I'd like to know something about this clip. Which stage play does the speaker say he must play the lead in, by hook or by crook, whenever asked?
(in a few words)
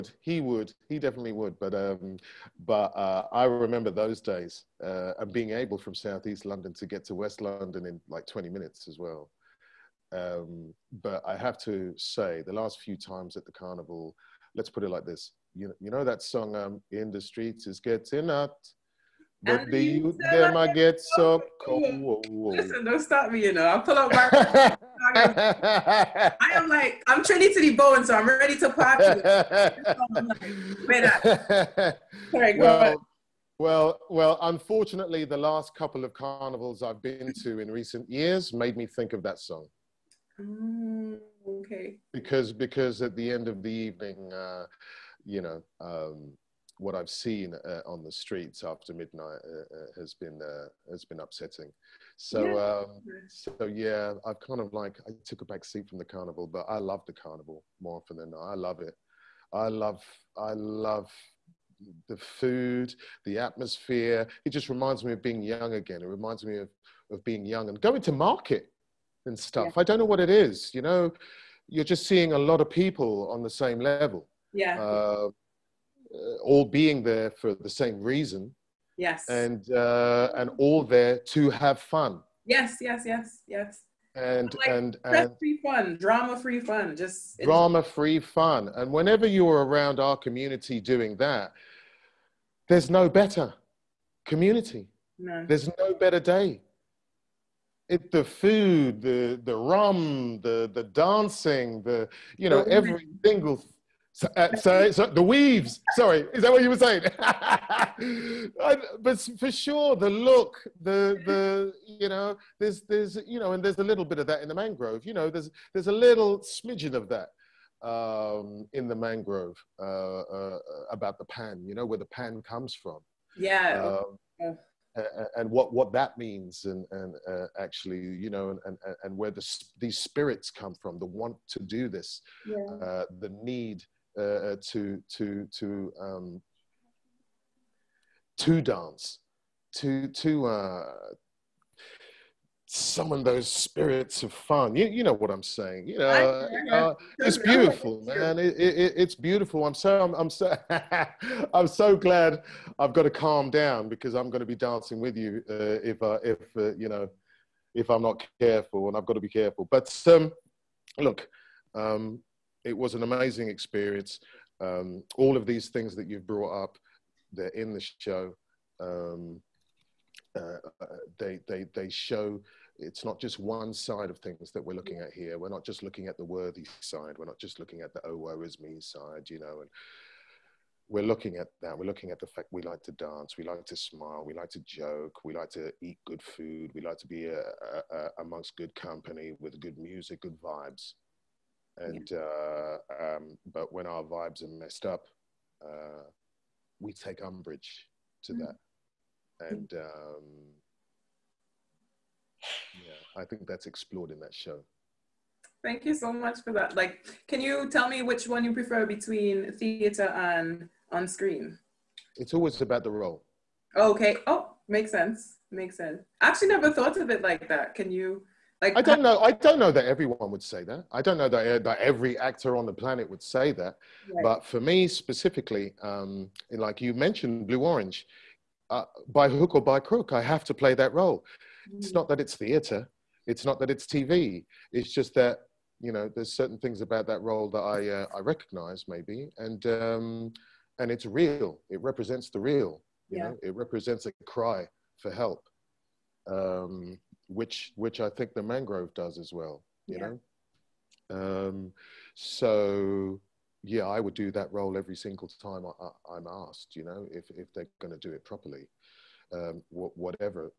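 Blue Orange.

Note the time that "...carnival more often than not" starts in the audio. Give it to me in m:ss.
0:57.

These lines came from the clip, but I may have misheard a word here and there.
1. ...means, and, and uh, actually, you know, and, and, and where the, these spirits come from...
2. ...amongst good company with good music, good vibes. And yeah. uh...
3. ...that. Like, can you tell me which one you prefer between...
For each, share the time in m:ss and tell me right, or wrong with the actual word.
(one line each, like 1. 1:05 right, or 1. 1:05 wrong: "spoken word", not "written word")
1. 2:06 right
2. 3:08 right
3. 3:26 right.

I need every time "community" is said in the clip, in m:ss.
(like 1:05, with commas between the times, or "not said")
1:30, 1:34.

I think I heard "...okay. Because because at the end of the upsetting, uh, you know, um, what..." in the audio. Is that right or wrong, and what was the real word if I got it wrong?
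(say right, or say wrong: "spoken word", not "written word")
wrong: "evening", not "upsetting".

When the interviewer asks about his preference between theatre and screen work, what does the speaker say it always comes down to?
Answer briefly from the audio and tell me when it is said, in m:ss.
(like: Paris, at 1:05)
The role, at 3:32.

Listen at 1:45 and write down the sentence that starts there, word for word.
Sorry, is that what you were saying?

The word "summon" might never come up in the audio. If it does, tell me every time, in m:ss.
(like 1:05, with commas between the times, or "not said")
2:22.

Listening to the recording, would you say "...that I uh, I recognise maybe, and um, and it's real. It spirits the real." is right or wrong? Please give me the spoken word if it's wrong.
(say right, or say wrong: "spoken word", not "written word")
wrong: "represents", not "spirits".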